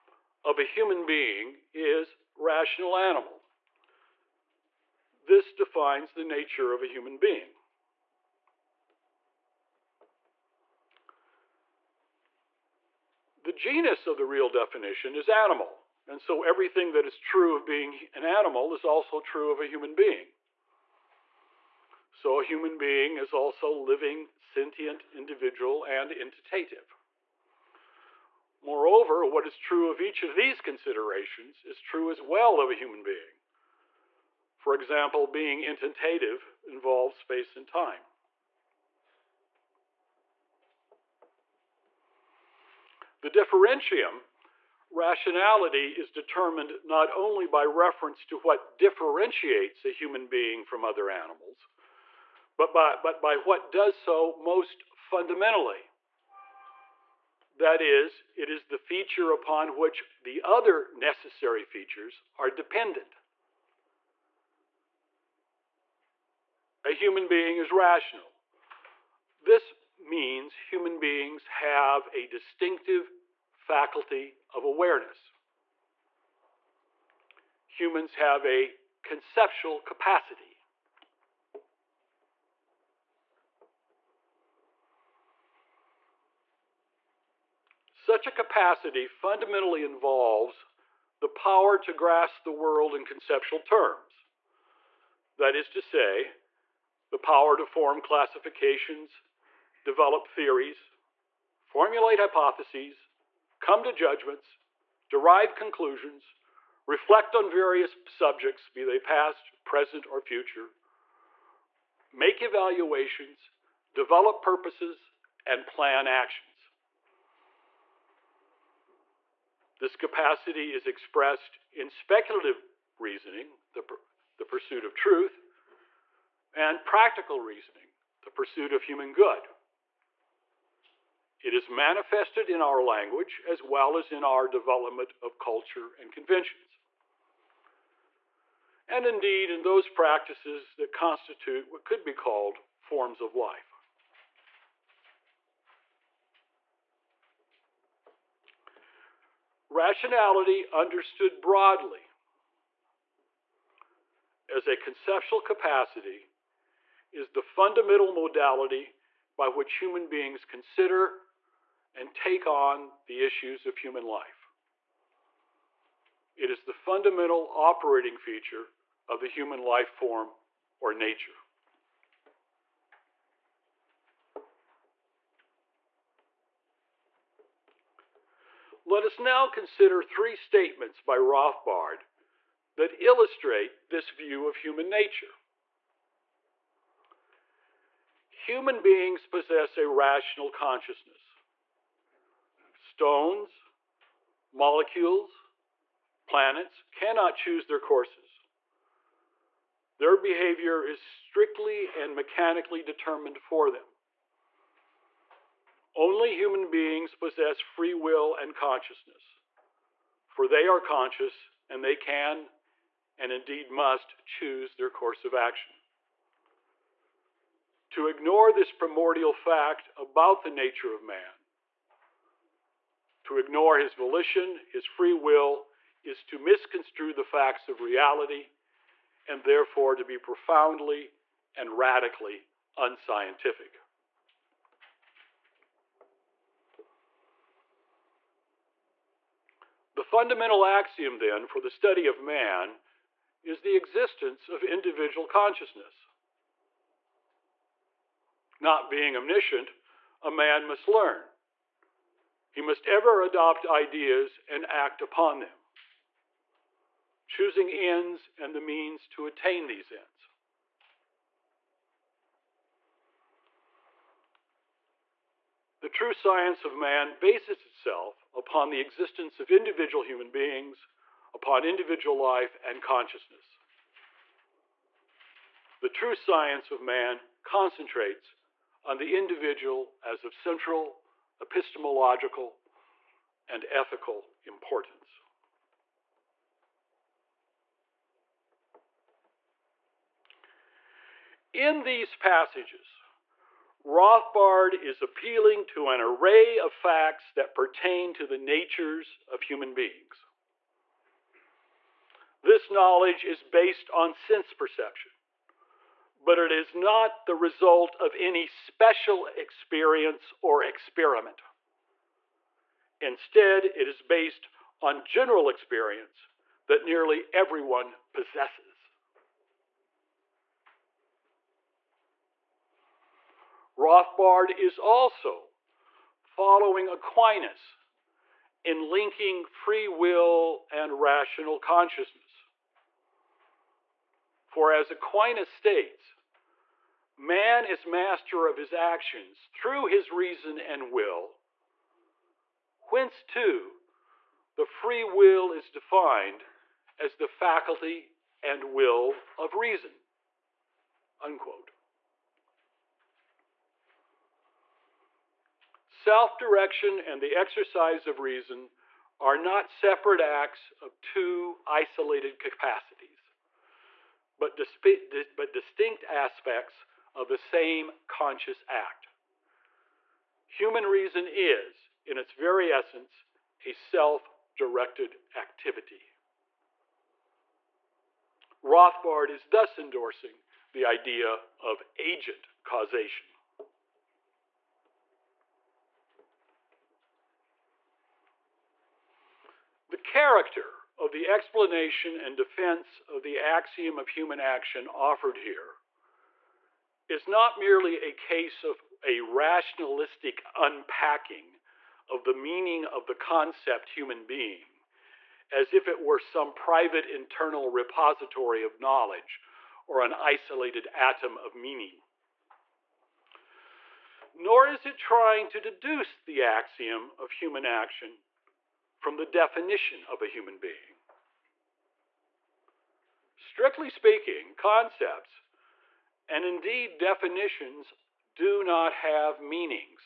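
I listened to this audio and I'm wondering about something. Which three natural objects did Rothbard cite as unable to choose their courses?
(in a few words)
Stones, molecules, planets.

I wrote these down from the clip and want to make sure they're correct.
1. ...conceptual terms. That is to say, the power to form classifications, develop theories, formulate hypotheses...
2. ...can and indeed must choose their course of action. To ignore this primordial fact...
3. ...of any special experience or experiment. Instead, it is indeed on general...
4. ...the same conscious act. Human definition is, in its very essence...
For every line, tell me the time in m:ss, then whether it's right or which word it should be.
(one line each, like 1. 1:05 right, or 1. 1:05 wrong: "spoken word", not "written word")
1. 1:33 right
2. 3:31 right
3. 5:07 wrong: "based", not "indeed"
4. 6:07 wrong: "reason", not "definition".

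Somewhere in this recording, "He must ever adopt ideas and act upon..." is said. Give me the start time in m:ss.
4:12.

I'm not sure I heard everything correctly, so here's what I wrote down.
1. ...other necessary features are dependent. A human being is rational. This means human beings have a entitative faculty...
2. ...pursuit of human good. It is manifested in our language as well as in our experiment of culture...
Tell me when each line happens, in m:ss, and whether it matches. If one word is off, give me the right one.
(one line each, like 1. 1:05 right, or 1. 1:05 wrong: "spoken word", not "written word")
1. 1:00 wrong: "distinctive", not "entitative"
2. 2:08 wrong: "development", not "experiment".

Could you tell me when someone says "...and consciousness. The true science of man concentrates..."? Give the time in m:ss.
4:32.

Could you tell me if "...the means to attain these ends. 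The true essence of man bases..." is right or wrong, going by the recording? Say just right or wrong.
wrong.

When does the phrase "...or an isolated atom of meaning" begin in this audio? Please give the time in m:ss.
6:49.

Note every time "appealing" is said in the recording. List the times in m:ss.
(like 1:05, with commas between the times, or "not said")
4:55.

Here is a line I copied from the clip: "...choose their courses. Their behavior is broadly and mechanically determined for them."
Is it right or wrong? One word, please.
wrong.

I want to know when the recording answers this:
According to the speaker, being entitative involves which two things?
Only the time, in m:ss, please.
0:37.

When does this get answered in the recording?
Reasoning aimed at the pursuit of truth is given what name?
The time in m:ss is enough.
2:01.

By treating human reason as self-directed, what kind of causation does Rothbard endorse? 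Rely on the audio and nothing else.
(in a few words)
agent causation.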